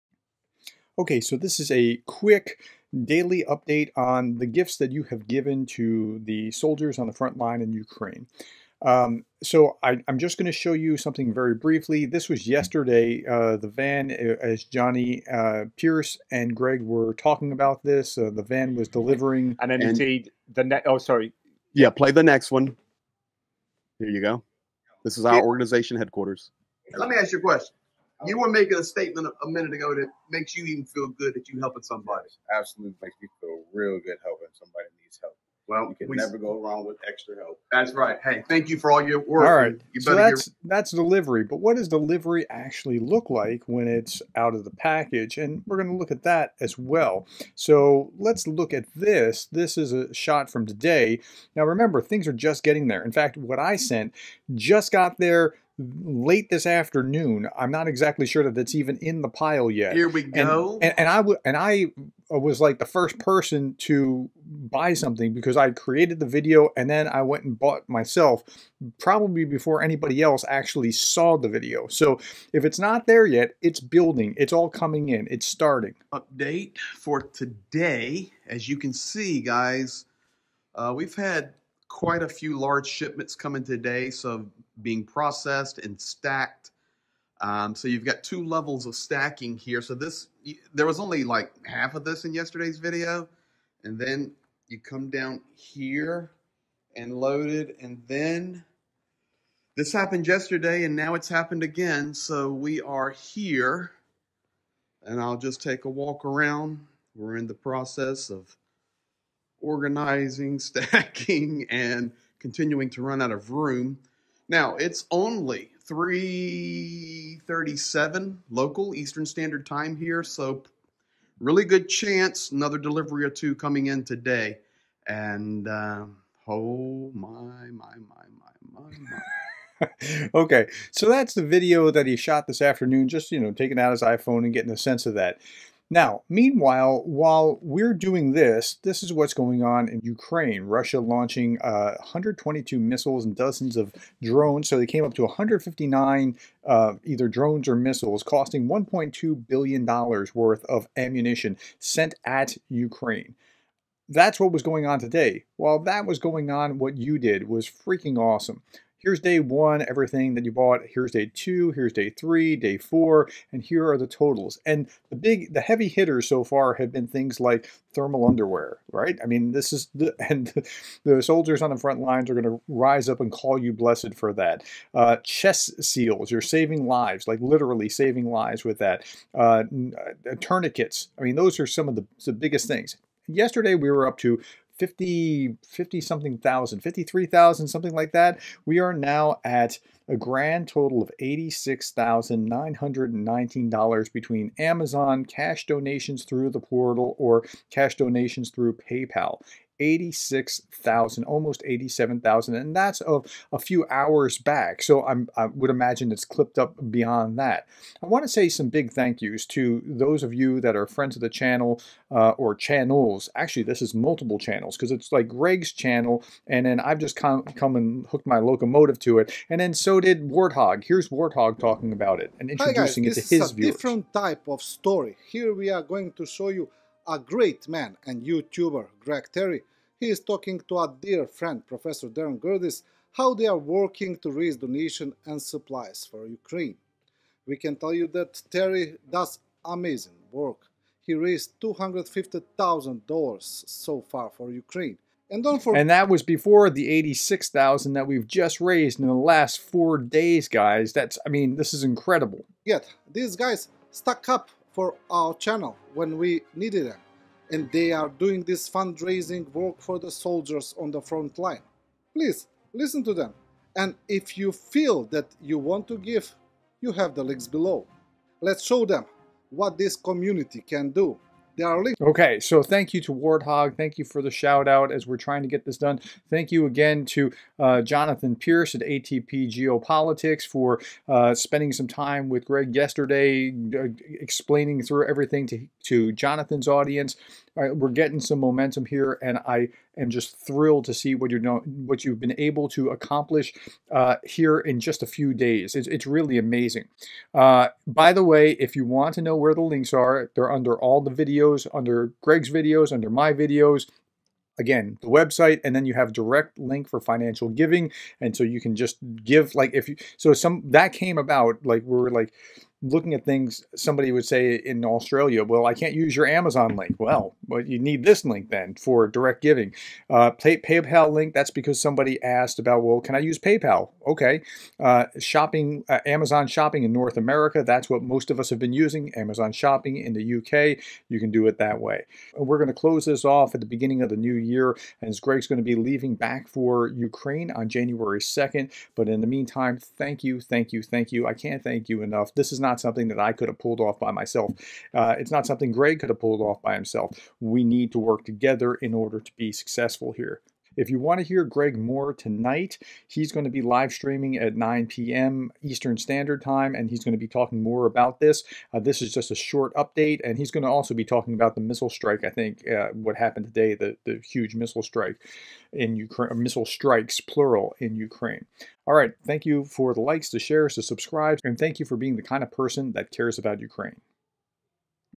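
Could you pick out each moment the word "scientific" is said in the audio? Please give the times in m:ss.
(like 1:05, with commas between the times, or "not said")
not said.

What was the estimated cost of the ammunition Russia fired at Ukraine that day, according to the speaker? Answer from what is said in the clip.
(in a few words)
$1.2 billion.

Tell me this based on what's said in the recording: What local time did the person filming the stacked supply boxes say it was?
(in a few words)
3:37.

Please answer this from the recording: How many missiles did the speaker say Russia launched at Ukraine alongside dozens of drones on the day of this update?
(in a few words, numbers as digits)
122.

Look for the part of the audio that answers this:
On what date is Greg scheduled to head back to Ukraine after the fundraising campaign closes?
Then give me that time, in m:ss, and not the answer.
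5:37.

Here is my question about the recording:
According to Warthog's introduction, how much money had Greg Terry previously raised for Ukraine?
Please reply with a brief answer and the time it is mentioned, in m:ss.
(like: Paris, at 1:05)
$250,000, at 4:01.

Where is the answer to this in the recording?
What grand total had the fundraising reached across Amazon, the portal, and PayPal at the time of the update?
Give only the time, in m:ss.
3:11.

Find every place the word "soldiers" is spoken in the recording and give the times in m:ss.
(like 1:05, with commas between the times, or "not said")
0:06, 2:51, 4:20.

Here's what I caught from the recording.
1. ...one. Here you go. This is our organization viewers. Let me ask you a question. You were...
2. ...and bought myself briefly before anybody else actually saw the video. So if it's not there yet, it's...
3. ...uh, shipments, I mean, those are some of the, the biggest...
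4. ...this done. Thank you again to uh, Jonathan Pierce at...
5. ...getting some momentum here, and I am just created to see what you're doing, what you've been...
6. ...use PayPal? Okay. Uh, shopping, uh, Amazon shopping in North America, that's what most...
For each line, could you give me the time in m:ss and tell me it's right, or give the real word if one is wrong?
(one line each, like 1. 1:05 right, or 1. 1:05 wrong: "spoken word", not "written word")
1. 0:22 wrong: "headquarters", not "viewers"
2. 1:07 wrong: "probably", not "briefly"
3. 2:59 wrong: "tourniquets", not "shipments"
4. 4:35 right
5. 4:47 wrong: "thrilled", not "created"
6. 5:23 right.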